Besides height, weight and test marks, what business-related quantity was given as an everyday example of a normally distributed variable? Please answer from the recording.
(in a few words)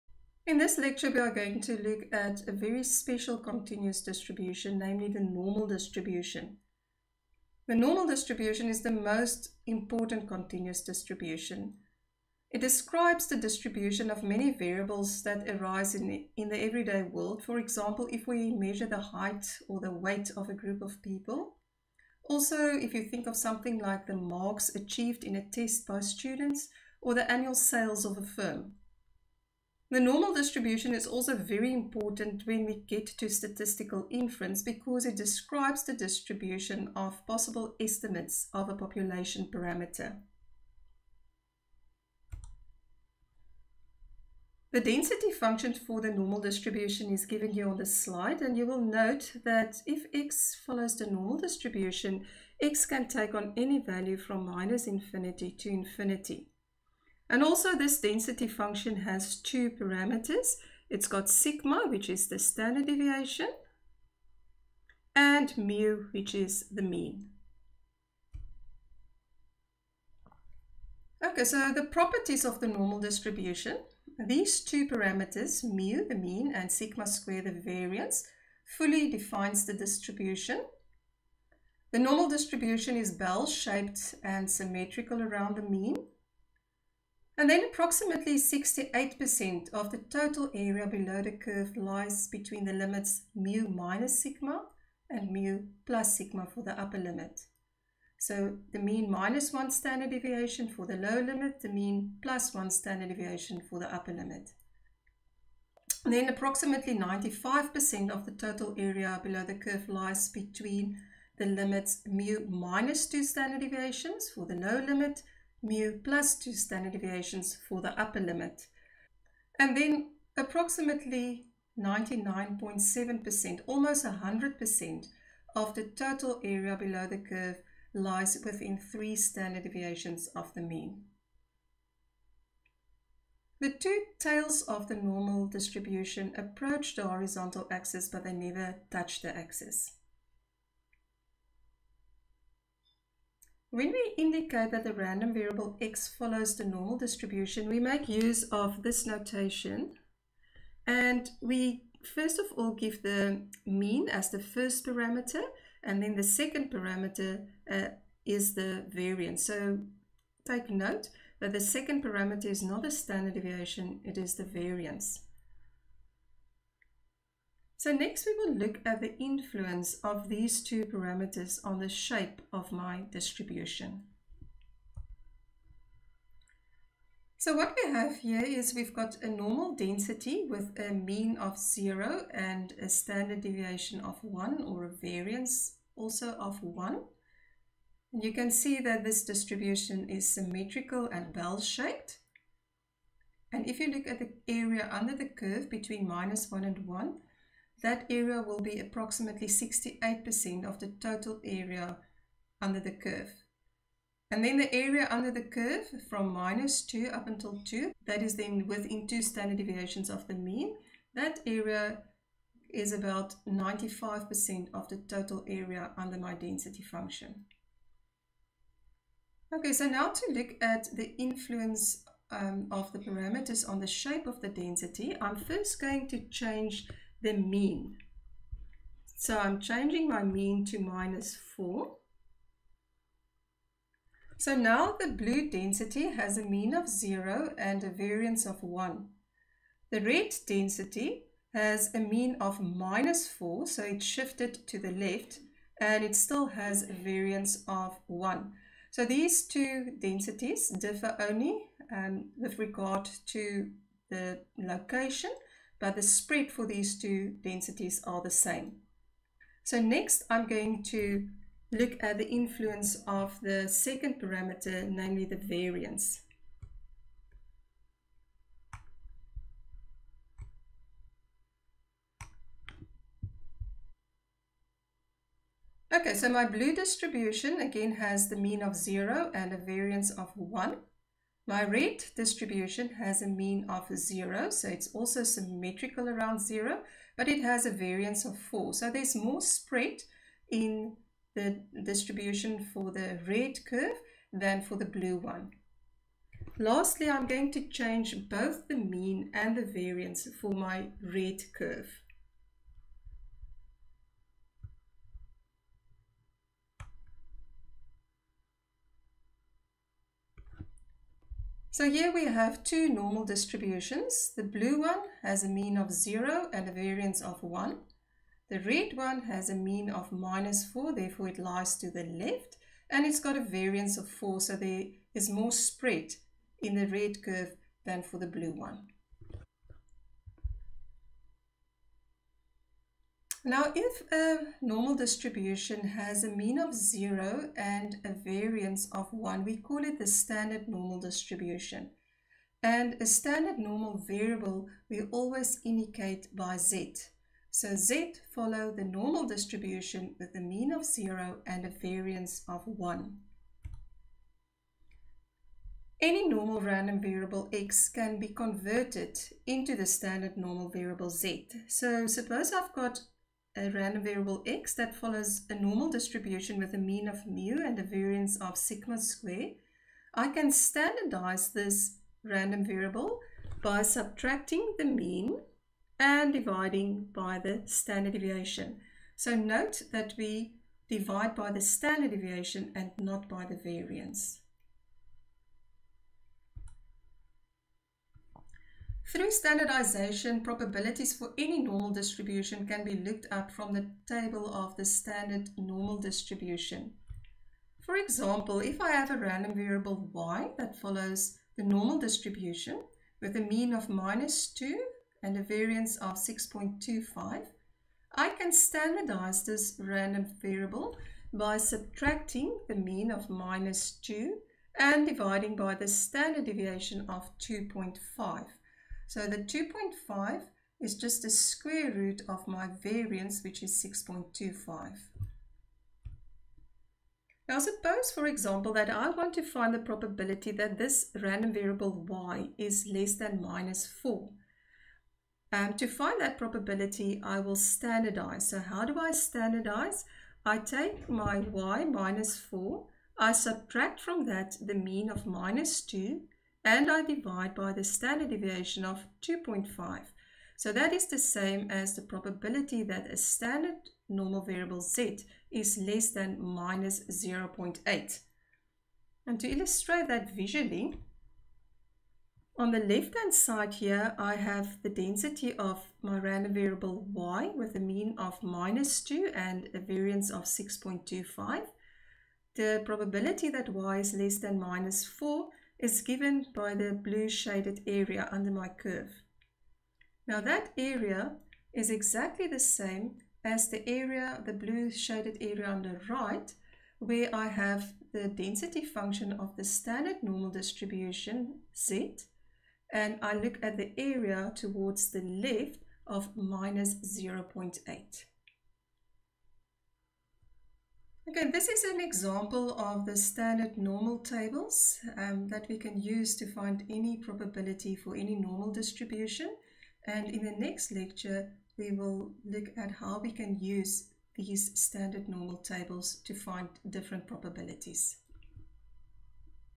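annual sales of a firm.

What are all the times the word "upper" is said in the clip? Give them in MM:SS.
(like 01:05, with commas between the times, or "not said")
01:36, 01:43, 01:57.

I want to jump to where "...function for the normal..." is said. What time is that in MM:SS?
00:45.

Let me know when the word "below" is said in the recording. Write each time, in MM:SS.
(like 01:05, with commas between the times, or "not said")
01:30, 01:49, 02:06.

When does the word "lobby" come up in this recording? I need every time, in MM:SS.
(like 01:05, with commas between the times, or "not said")
not said.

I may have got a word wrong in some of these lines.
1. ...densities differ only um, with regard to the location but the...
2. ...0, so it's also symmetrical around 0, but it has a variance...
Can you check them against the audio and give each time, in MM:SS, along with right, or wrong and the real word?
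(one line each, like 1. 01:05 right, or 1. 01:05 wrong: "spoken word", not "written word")
1. 04:09 right
2. 04:43 right.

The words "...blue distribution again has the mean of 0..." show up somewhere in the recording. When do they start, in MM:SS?
04:36.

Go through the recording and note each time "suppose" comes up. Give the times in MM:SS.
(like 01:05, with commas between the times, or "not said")
06:02, 07:07.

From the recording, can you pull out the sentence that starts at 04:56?
Lastly, I'm going to change both the mean and the variance for my red curve.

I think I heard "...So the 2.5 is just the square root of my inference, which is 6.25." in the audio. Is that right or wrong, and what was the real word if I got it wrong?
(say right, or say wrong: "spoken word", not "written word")
wrong: "variance", not "inference".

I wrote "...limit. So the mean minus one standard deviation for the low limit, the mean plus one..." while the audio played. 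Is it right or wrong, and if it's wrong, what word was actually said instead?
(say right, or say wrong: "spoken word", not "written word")
right.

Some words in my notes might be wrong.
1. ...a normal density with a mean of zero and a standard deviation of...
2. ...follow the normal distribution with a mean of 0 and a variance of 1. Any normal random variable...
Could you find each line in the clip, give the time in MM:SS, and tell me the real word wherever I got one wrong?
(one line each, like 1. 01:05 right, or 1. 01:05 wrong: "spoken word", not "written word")
1. 02:59 right
2. 05:48 right.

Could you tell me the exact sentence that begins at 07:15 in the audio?
Um, to find that probability, I will standardize.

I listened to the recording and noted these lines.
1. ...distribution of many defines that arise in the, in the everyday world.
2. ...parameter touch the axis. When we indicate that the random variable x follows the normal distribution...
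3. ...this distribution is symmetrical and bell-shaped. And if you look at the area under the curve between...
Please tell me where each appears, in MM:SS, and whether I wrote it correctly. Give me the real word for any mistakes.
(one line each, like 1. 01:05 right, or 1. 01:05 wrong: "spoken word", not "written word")
1. 00:13 wrong: "variables", not "defines"
2. 02:18 wrong: "never", not "parameter"
3. 03:09 right.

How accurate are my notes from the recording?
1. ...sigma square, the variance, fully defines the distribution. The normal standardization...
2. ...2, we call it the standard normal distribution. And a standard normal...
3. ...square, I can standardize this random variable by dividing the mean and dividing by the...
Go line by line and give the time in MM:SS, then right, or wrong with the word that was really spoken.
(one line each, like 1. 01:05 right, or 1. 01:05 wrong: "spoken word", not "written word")
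1. 01:16 wrong: "distribution", not "standardization"
2. 05:39 wrong: "1", not "2"
3. 06:08 wrong: "subtracting", not "dividing".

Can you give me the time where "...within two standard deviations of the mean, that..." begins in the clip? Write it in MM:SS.
03:28.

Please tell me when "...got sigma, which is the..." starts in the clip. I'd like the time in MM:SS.
01:01.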